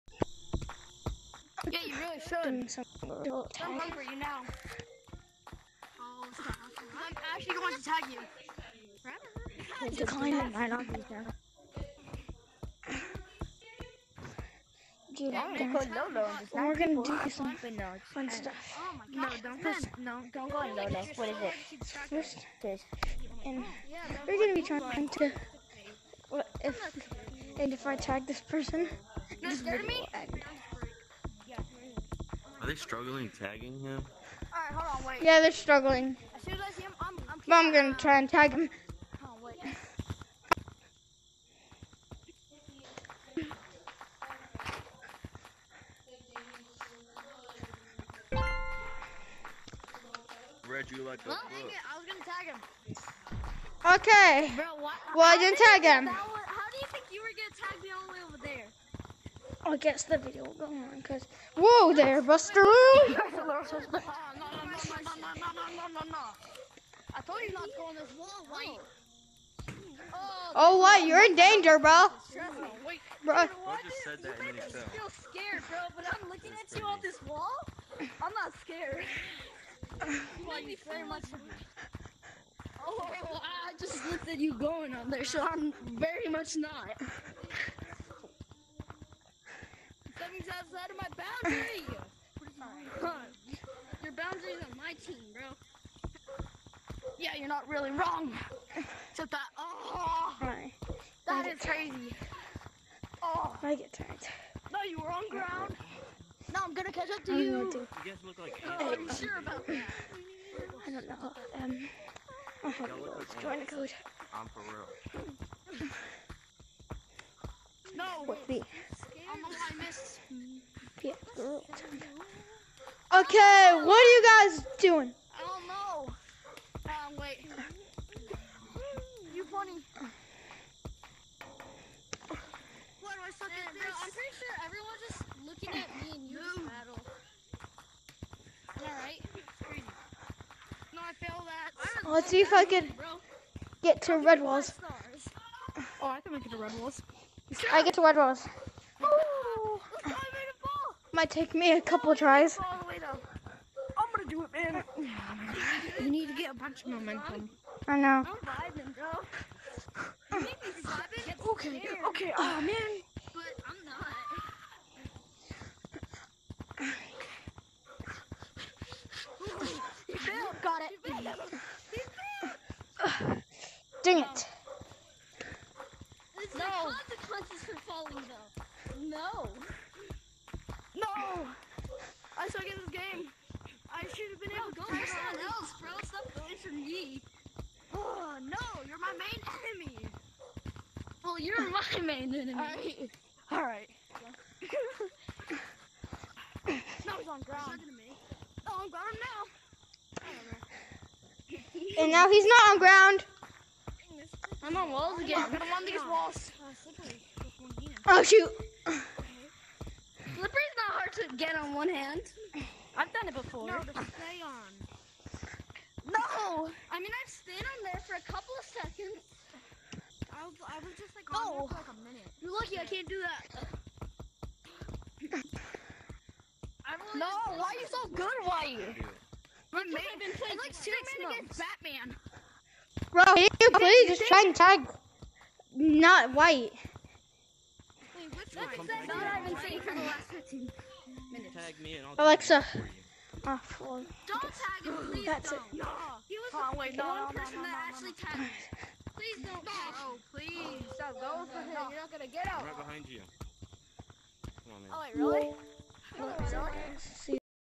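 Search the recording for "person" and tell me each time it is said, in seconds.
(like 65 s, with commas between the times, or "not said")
28 s, 247 s.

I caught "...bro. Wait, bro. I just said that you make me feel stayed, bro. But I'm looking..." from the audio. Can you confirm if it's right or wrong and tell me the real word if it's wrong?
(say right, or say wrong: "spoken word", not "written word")
wrong: "scared", not "stayed".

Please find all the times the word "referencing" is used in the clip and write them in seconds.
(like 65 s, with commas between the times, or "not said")
not said.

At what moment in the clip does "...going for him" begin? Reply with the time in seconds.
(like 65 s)
251 s.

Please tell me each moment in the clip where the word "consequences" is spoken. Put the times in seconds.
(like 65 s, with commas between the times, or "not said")
176 s.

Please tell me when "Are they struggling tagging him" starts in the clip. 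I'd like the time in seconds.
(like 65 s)
32 s.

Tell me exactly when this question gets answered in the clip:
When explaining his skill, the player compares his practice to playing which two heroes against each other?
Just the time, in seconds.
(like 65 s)
230 s.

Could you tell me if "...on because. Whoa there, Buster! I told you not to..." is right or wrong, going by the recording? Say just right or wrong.
right.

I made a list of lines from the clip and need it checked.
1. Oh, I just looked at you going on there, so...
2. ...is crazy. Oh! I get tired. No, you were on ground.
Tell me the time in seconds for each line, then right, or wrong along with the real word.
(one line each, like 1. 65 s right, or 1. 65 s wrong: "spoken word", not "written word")
1. 82 s right
2. 101 s right.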